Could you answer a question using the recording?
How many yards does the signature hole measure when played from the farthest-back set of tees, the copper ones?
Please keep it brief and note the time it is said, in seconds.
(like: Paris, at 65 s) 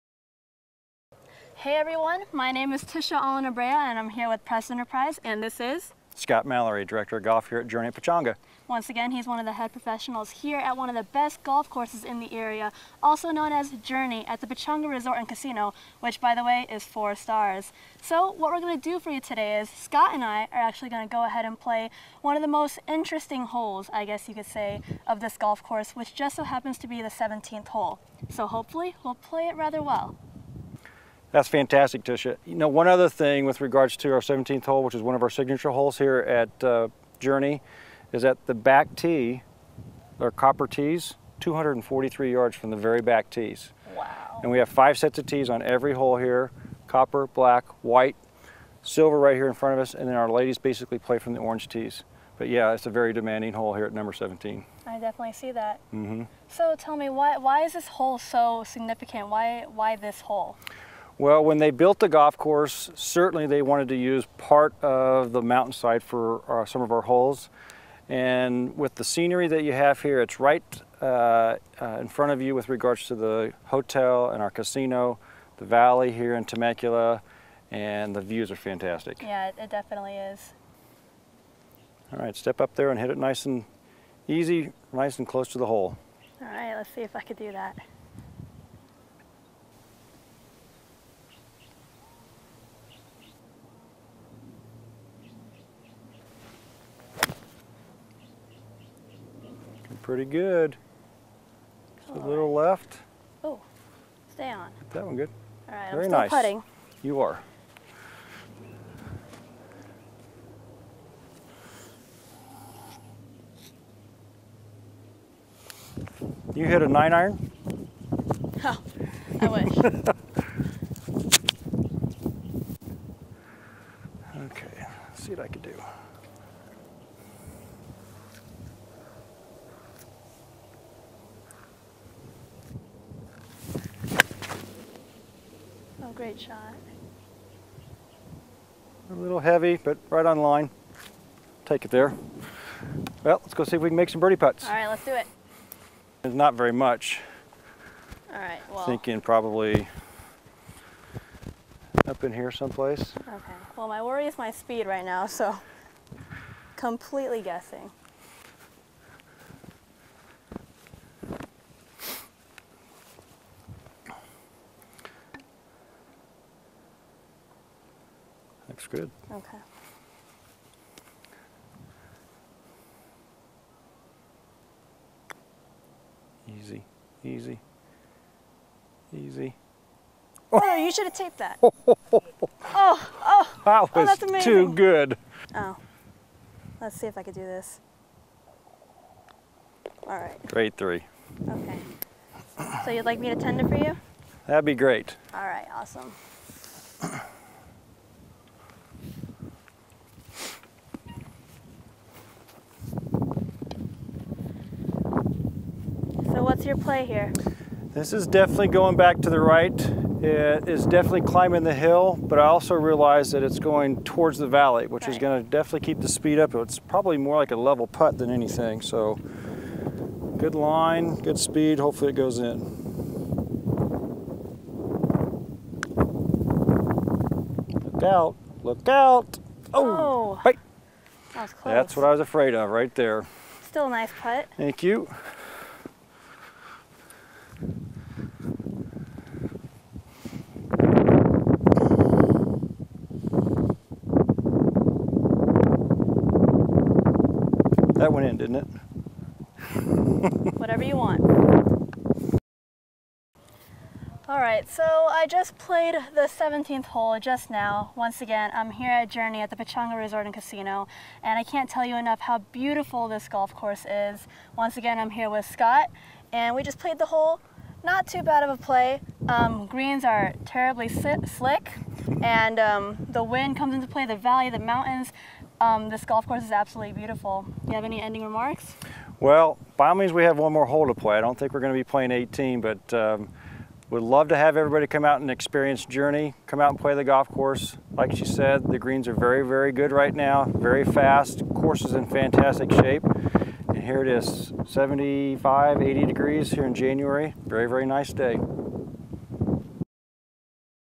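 243, at 41 s.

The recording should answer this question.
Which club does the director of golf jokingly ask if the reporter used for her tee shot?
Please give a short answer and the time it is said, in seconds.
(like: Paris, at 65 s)
nine iron, at 116 s.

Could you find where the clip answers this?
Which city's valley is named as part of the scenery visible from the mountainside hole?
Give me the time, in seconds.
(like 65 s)
76 s.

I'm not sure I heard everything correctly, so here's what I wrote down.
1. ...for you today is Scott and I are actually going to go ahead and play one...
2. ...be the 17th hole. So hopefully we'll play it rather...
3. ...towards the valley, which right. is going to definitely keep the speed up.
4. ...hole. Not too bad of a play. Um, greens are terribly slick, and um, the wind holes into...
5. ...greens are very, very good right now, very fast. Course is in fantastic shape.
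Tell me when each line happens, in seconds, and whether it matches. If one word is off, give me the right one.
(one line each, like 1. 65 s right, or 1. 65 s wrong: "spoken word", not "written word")
1. 18 s right
2. 26 s right
3. 214 s right
4. 267 s wrong: "comes", not "holes"
5. 288 s right.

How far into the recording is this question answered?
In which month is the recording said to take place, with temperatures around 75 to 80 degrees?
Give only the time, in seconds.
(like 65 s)
296 s.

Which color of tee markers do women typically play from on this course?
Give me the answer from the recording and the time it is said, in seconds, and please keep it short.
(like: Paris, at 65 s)
orange, at 51 s.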